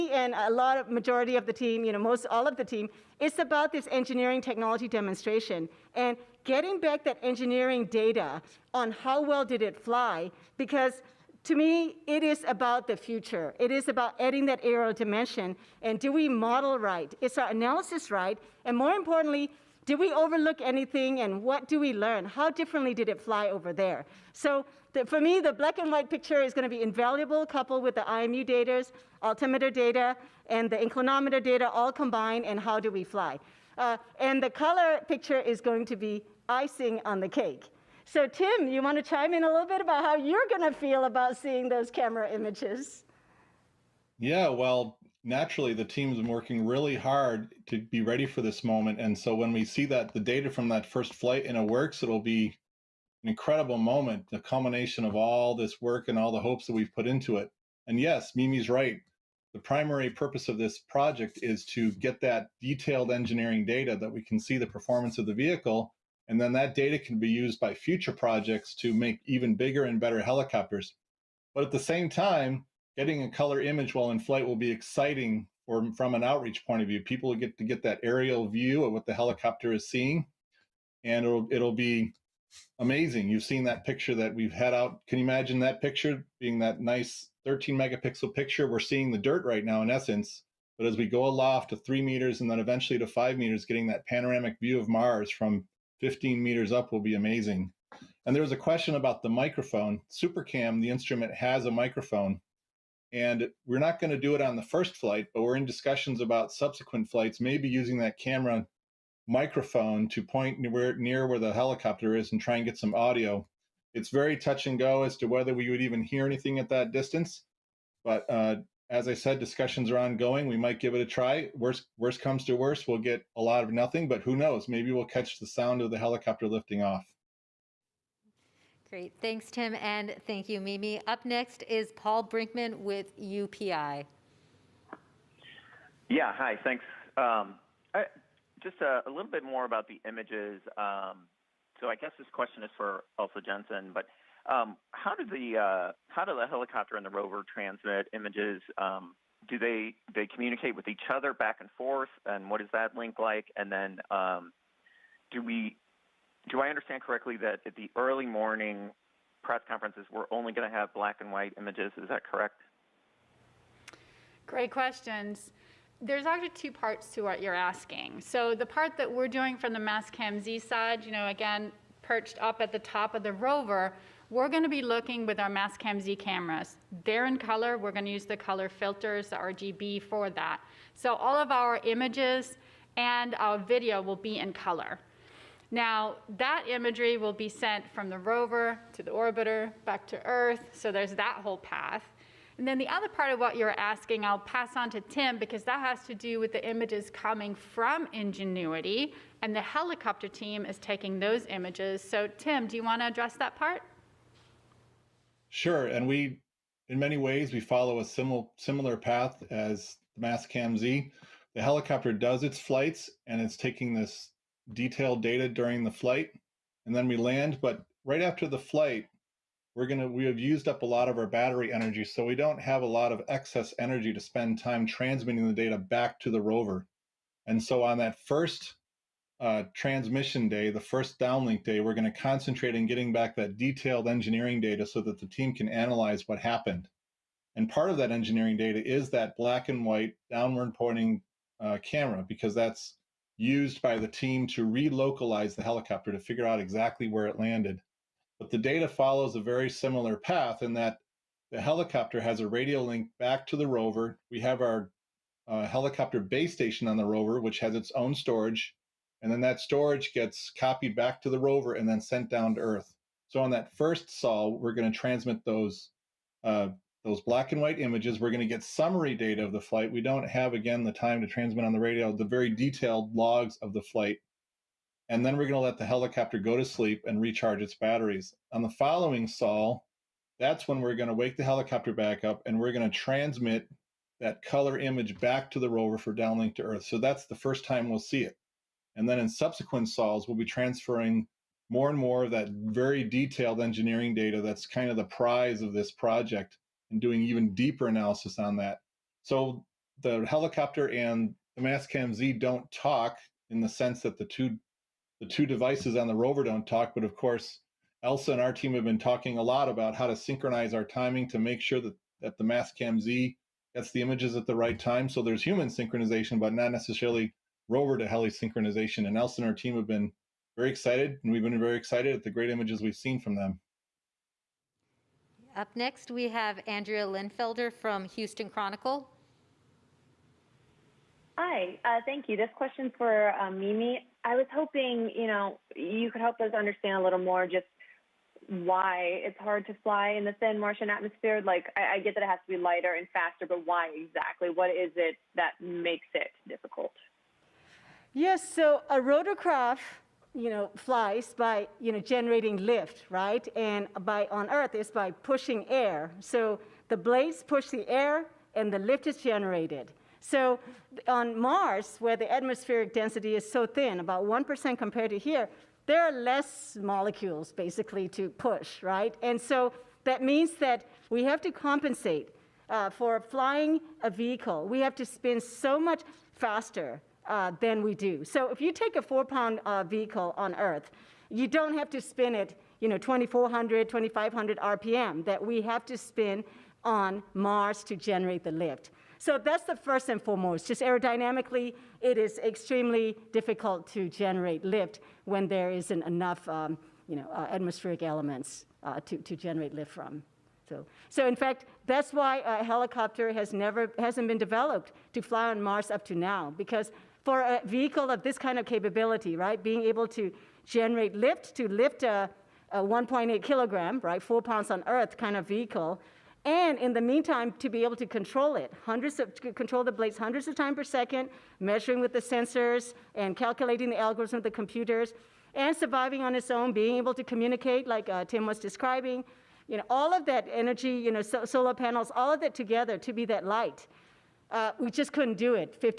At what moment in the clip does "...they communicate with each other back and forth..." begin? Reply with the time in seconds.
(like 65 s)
149 s.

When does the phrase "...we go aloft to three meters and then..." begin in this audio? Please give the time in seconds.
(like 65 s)
90 s.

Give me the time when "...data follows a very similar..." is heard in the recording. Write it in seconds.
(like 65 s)
248 s.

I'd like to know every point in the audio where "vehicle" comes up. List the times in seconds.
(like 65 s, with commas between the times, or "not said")
65 s, 374 s, 379 s, 407 s, 415 s.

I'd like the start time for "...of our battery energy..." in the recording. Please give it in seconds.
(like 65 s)
221 s.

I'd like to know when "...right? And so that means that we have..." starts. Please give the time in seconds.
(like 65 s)
368 s.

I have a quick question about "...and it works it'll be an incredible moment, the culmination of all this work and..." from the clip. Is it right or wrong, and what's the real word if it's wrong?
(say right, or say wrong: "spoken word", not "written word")
right.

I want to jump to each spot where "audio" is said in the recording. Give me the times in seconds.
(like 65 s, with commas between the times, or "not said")
112 s.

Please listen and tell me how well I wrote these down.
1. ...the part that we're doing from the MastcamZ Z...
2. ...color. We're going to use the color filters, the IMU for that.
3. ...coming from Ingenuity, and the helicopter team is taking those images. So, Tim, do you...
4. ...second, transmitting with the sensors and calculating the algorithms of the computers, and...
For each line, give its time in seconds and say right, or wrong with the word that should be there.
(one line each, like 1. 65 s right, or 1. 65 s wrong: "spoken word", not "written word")
1. 168 s wrong: "Cam", not "MastcamZ"
2. 177 s wrong: "RGB", not "IMU"
3. 197 s right
4. 420 s wrong: "measuring", not "transmitting".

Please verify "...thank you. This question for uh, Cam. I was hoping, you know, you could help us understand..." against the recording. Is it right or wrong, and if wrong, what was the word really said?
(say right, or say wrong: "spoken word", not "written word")
wrong: "Mimi", not "Cam".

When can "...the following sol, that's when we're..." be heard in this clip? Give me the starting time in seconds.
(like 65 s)
278 s.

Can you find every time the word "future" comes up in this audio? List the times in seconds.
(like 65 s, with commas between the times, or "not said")
12 s, 67 s.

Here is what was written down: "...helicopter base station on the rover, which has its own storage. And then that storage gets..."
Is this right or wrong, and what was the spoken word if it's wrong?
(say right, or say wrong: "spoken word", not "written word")
right.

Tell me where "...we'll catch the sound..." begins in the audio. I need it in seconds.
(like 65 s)
124 s.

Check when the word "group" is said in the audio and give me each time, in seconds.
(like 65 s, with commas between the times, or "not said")
not said.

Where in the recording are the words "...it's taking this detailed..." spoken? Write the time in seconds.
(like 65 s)
213 s.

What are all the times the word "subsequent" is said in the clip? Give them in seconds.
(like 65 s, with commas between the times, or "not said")
106 s, 289 s.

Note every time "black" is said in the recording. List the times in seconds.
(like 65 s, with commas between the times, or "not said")
25 s, 160 s, 239 s, 267 s.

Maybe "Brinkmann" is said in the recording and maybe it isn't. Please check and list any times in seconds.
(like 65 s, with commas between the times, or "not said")
132 s.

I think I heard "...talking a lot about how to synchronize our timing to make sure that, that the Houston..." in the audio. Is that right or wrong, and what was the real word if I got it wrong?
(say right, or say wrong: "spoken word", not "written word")
wrong: "Cam", not "Houston".